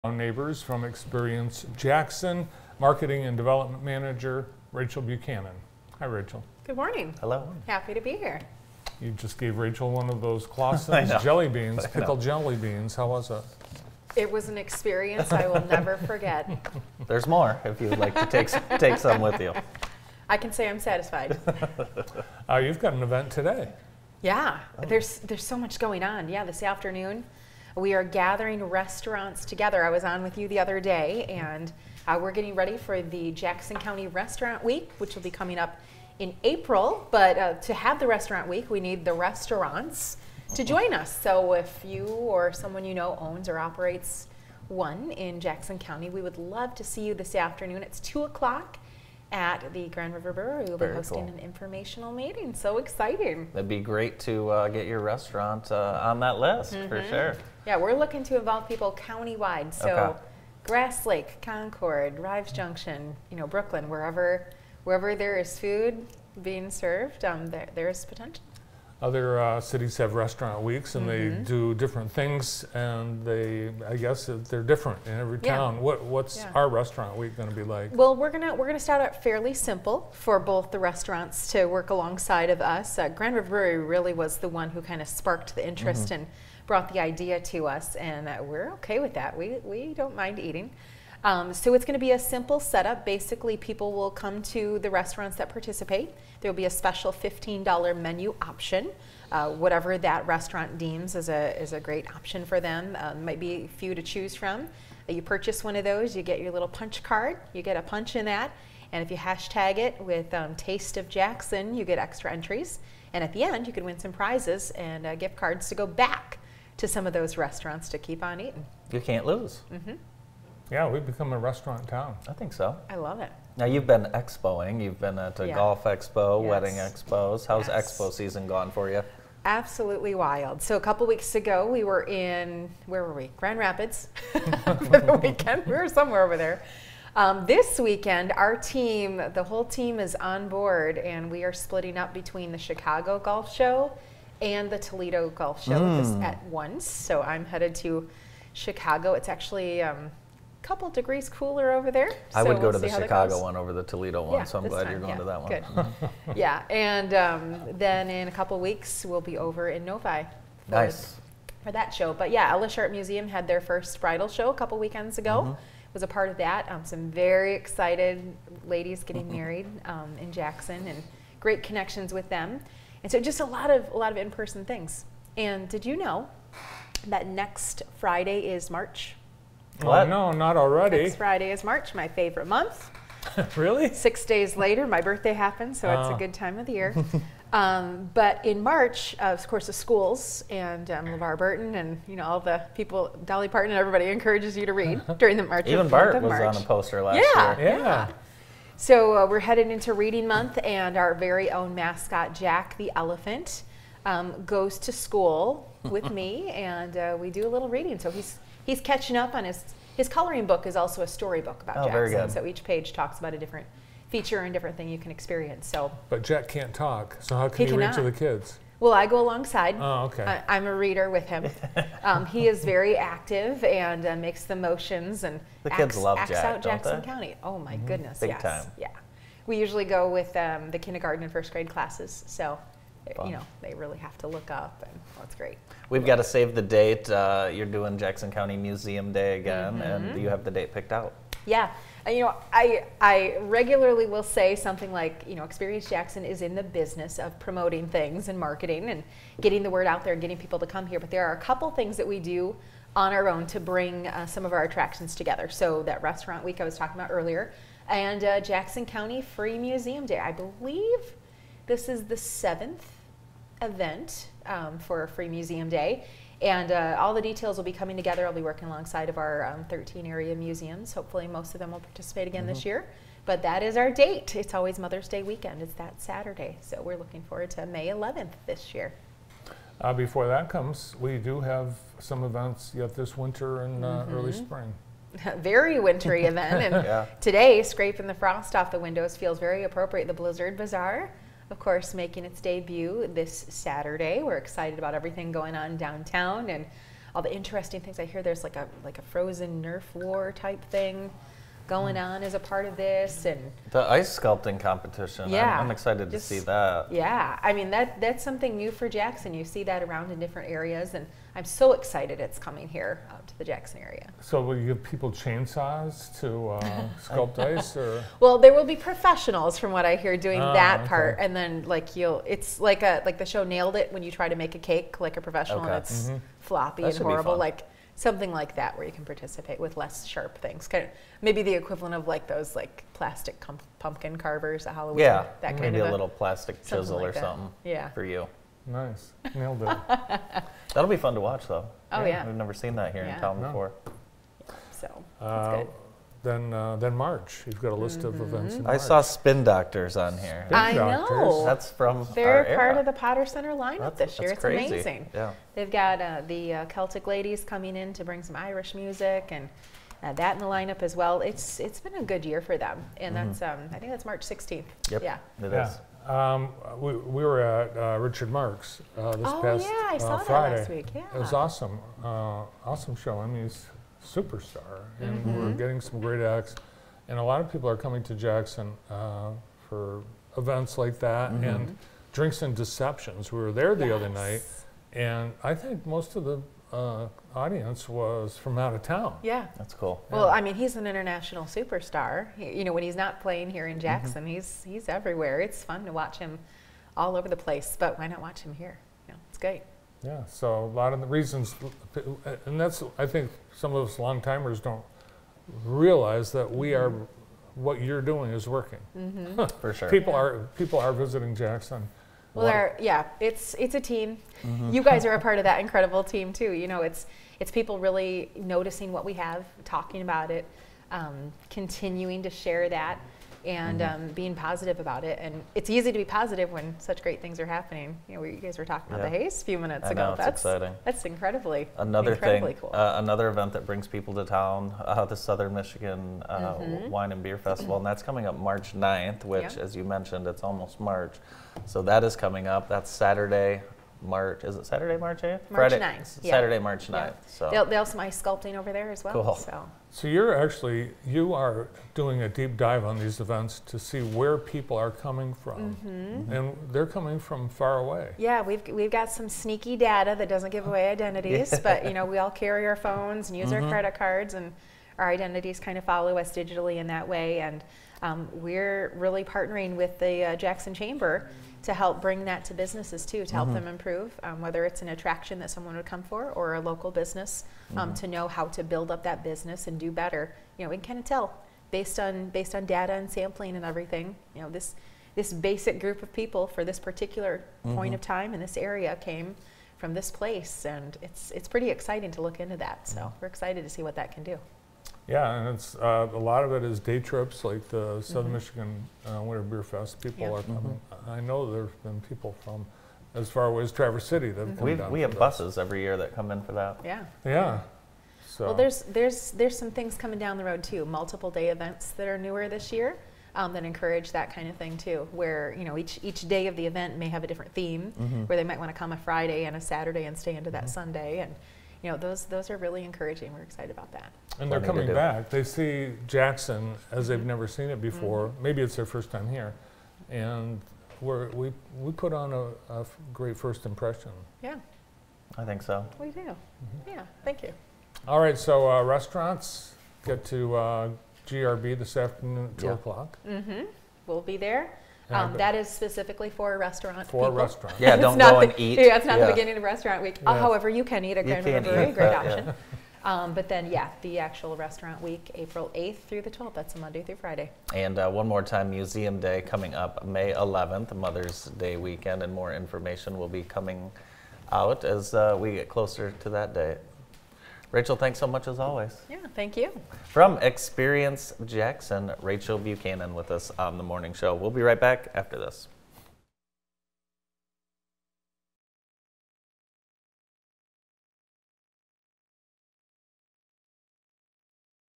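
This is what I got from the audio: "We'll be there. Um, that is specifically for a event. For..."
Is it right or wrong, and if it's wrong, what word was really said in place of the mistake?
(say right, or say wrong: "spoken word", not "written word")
wrong: "restaurant", not "event".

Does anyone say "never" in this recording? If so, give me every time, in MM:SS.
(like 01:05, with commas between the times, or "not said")
00:15, 05:42, 08:47.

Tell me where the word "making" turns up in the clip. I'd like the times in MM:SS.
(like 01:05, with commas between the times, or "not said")
04:51.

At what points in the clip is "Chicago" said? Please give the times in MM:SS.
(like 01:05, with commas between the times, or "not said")
02:22, 02:28, 02:32.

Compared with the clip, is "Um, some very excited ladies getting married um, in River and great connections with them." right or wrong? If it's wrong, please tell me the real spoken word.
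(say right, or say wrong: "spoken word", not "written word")
wrong: "Jackson", not "River".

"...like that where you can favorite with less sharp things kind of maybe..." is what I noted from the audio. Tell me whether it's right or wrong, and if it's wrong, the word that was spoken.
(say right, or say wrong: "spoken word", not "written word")
wrong: "participate", not "favorite".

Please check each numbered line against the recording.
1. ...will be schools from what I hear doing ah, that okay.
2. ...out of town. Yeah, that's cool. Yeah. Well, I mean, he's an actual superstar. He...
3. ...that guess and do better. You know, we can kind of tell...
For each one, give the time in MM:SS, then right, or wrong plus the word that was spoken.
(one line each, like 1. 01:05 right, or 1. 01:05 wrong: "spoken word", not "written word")
1. 05:18 wrong: "professionals", not "schools"
2. 06:28 wrong: "international", not "actual"
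3. 07:59 wrong: "business", not "guess".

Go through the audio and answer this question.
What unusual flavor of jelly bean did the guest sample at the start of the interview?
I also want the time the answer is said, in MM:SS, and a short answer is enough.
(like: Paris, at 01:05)
Pickled, at 00:11.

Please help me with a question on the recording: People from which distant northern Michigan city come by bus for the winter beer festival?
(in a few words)
Traverse City.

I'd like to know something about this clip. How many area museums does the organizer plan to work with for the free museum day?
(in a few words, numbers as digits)
13.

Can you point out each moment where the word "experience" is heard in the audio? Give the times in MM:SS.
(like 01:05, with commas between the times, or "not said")
00:00, 00:14, 03:35, 04:05, 09:30.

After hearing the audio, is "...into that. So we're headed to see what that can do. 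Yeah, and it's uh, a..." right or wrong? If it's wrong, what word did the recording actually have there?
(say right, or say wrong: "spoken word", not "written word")
wrong: "excited", not "headed".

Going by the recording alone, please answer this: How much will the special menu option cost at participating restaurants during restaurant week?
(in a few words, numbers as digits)
$15.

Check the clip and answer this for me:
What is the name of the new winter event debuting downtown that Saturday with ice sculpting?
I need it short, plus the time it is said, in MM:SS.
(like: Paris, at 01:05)
Blizzard Bazaar, at 04:50.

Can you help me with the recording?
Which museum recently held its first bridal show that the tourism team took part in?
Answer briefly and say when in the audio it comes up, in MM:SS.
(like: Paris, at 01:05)
Ella Sharp Museum, at 02:42.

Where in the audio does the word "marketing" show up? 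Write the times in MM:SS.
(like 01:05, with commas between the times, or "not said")
00:02, 04:08.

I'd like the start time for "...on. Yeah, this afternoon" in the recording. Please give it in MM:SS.
00:26.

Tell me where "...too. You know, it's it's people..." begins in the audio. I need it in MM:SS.
06:56.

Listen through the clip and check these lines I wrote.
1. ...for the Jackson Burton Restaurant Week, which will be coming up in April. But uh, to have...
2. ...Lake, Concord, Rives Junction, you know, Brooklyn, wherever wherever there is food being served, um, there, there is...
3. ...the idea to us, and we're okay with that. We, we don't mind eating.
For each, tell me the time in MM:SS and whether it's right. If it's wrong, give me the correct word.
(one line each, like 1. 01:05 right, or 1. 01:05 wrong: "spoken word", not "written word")
1. 00:32 wrong: "County", not "Burton"
2. 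01:01 right
3. 01:26 right.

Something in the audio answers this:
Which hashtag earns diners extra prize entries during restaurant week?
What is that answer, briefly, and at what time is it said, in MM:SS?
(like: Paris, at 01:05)
Taste of Jackson, at 01:50.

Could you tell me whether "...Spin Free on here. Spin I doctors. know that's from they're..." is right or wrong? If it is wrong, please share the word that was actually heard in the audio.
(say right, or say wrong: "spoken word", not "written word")
wrong: "Doctors", not "Free".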